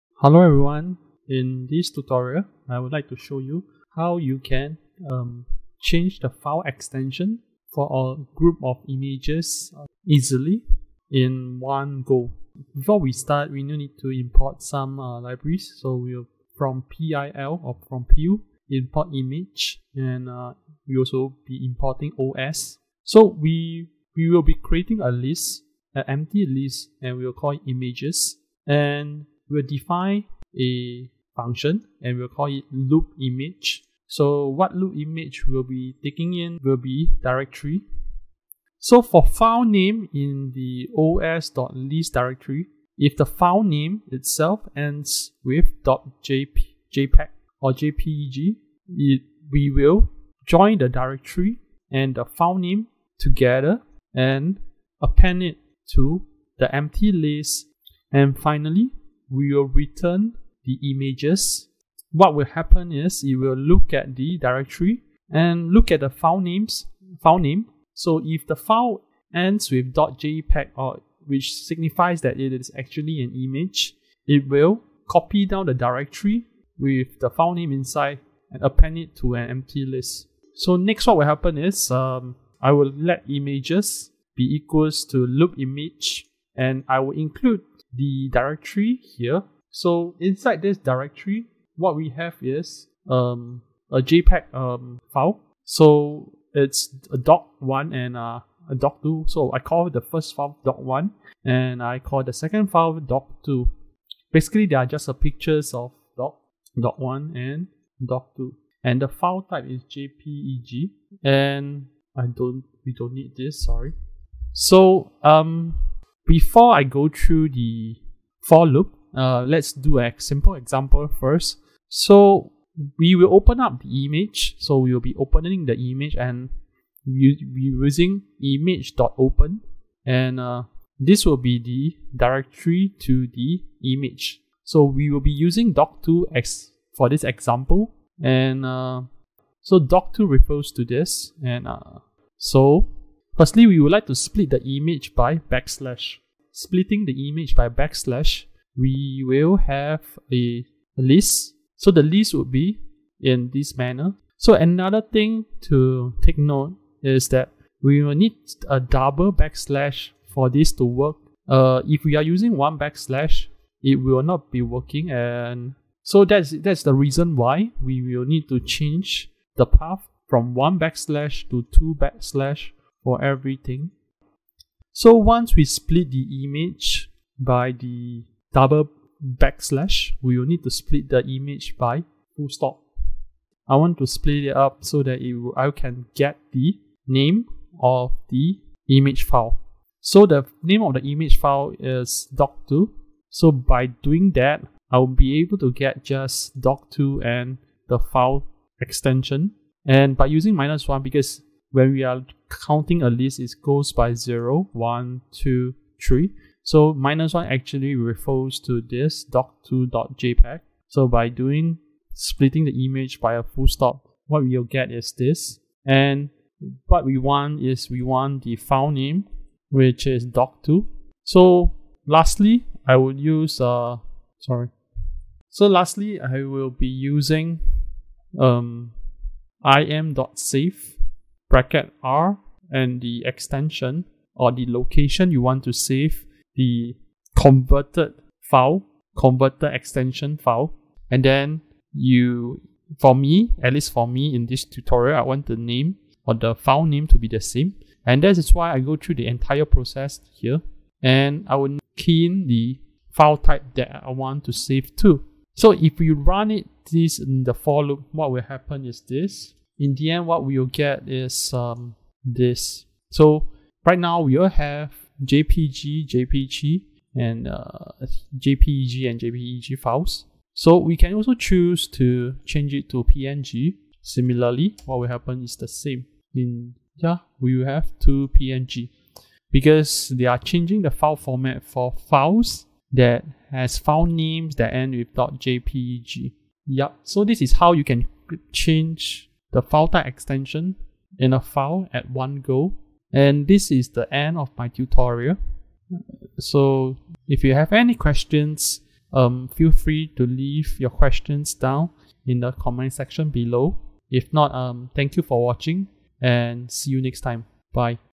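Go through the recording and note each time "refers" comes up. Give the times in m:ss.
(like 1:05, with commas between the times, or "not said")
2:20, 3:27.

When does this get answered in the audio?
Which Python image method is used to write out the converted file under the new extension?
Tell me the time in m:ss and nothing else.
3:49.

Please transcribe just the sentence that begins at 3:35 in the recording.
And what we want is we want the file name, which is doc2.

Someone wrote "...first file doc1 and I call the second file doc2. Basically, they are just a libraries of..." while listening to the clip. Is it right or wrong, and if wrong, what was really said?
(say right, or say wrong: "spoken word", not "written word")
wrong: "pictures", not "libraries".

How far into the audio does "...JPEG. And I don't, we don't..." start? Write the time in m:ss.
1:49.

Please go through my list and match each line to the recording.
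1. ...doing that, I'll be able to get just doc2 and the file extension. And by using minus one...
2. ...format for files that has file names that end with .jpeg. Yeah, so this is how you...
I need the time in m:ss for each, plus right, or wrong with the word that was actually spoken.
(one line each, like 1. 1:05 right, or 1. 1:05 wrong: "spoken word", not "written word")
1. 3:13 right
2. 4:41 right.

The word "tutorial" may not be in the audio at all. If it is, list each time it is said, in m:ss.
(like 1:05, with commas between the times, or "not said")
0:01, 4:04, 4:54.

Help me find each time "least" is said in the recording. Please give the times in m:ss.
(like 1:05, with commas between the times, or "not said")
4:03.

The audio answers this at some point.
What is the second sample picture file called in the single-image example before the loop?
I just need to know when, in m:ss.
2:14.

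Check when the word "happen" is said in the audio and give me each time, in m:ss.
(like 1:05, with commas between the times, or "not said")
1:02, 1:21, 4:18, 4:35.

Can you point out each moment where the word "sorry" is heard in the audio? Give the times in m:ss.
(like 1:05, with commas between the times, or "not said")
1:53, 3:44.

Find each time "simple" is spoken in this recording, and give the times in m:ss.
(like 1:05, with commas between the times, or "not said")
2:00.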